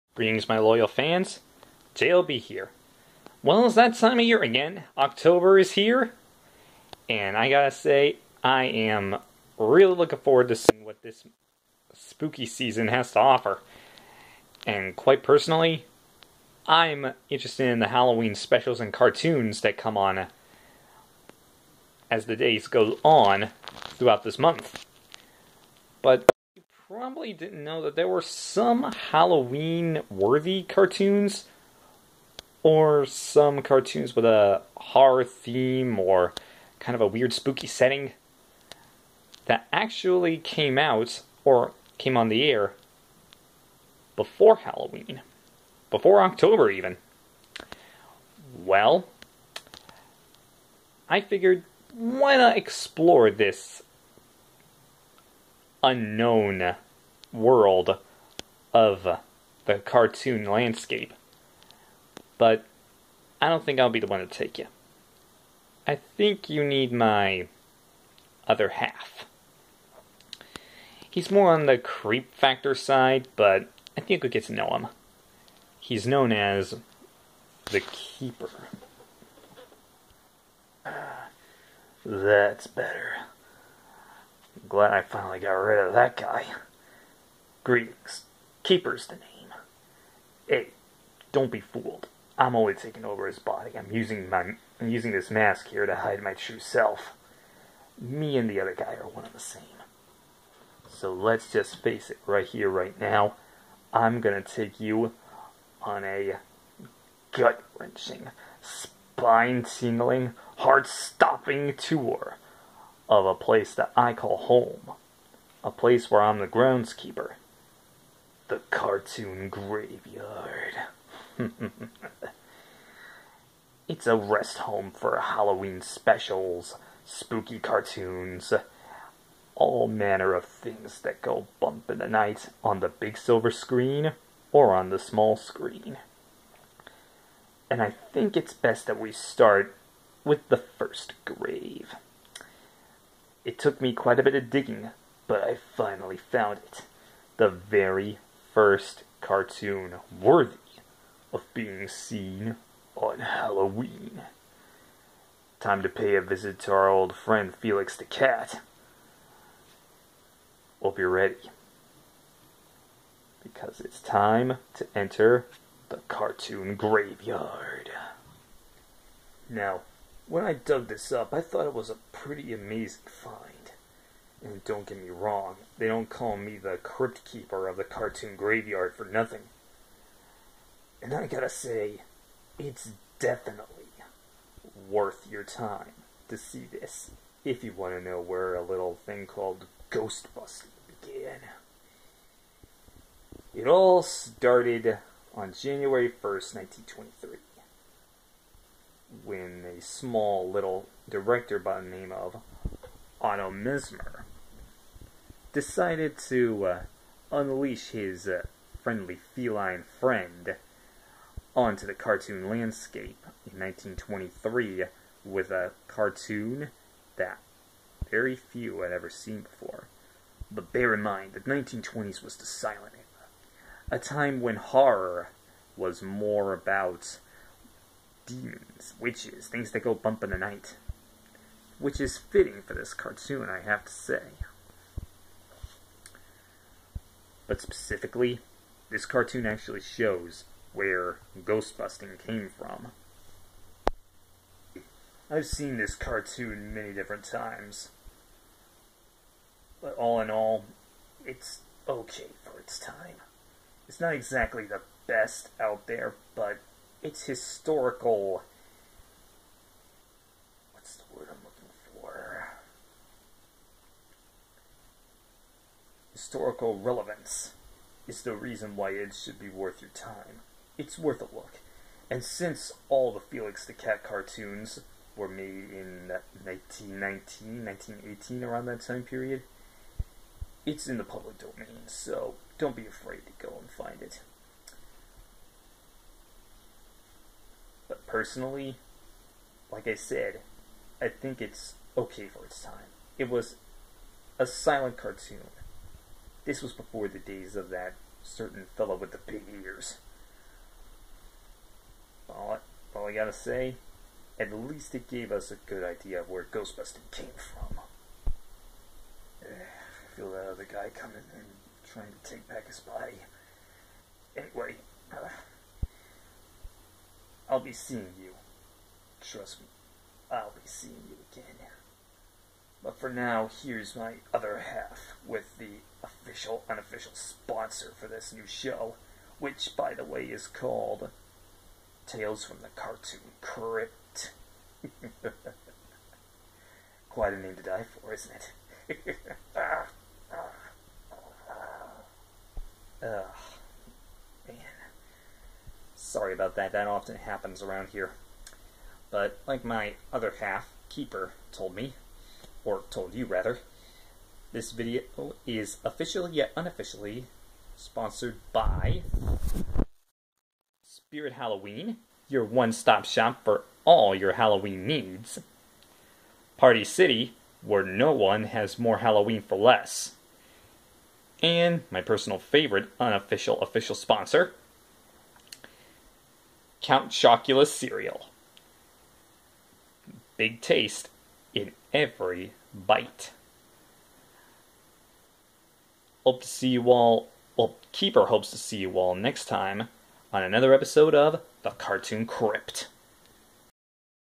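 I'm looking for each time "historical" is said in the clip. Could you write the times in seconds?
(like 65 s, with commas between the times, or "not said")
257 s, 266 s.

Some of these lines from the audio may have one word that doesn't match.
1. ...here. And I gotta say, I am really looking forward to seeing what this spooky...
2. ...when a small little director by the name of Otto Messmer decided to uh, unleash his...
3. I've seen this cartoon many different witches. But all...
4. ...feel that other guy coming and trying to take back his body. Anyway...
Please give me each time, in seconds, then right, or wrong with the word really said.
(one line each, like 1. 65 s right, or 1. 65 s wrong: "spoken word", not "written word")
1. 5 s right
2. 199 s right
3. 245 s wrong: "times", not "witches"
4. 310 s right.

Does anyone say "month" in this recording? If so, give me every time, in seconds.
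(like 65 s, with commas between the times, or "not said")
24 s.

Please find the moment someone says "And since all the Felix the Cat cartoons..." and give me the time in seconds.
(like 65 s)
272 s.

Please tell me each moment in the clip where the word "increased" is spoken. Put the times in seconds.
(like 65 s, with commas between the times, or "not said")
not said.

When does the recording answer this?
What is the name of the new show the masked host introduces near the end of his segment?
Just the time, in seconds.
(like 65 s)
332 s.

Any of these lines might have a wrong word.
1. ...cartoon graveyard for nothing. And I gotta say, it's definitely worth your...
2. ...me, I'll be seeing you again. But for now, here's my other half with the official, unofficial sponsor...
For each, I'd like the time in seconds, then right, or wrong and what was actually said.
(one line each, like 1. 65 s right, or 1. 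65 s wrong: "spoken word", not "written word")
1. 177 s right
2. 319 s right.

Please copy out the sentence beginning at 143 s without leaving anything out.
It took me quite a bit of digging, but I finally found it.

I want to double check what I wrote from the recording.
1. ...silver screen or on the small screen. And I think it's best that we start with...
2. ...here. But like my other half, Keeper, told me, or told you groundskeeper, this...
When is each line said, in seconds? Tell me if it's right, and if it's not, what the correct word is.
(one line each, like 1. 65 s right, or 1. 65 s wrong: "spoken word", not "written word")
1. 133 s right
2. 347 s wrong: "rather", not "groundskeeper".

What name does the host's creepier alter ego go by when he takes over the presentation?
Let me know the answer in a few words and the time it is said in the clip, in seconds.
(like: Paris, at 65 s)
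The Keeper, at 77 s.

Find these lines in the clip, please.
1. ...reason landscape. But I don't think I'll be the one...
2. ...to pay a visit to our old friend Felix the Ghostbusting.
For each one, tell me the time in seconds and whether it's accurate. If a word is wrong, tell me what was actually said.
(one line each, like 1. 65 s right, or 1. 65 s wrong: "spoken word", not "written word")
1. 59 s wrong: "cartoon", not "reason"
2. 155 s wrong: "Cat", not "Ghostbusting".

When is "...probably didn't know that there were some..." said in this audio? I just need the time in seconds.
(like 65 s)
26 s.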